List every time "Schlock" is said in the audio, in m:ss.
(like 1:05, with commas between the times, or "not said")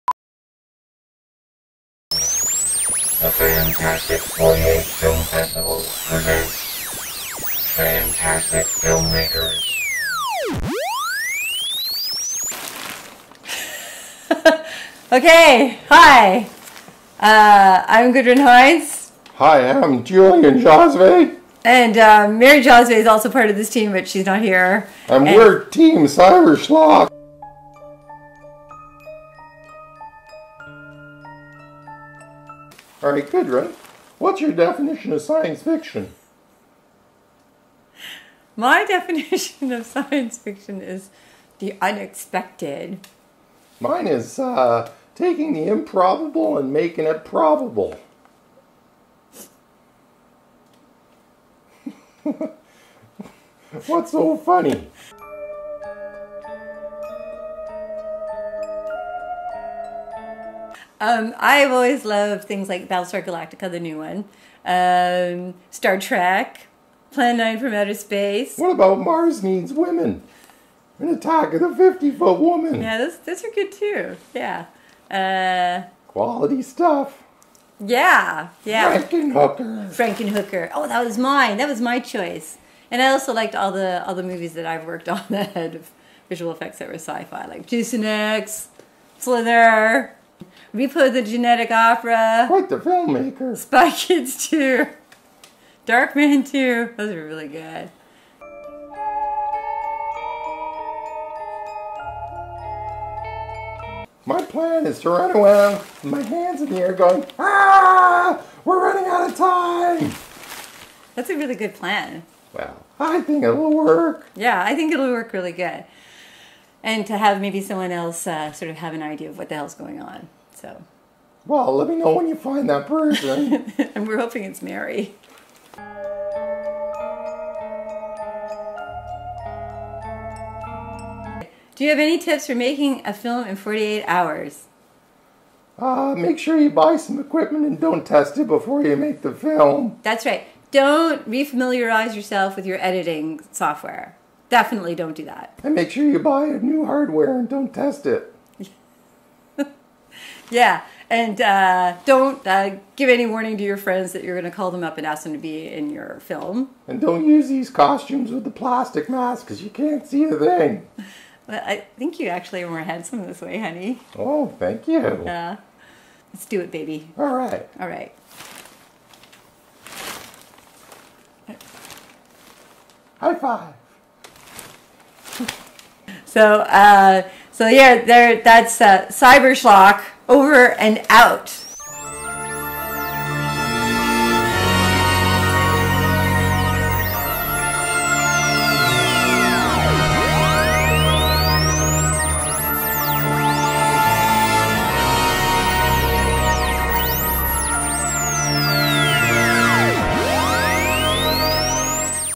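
0:26, 2:59.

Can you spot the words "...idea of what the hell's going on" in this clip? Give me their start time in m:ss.
1:59.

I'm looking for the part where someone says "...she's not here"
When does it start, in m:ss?
0:24.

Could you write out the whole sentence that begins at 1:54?
Yeah, I think it'll work really good.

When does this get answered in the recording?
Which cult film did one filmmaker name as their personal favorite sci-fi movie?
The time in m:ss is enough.
1:19.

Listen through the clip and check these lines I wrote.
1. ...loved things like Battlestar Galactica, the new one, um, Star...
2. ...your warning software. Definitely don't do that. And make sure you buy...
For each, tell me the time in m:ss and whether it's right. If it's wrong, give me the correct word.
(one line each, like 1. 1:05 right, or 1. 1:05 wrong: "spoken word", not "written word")
1. 1:02 right
2. 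2:22 wrong: "editing", not "warning".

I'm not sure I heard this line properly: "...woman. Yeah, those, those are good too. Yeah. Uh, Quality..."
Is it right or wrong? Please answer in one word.
right.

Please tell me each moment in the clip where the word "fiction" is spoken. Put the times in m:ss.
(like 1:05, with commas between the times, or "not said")
0:35, 0:40.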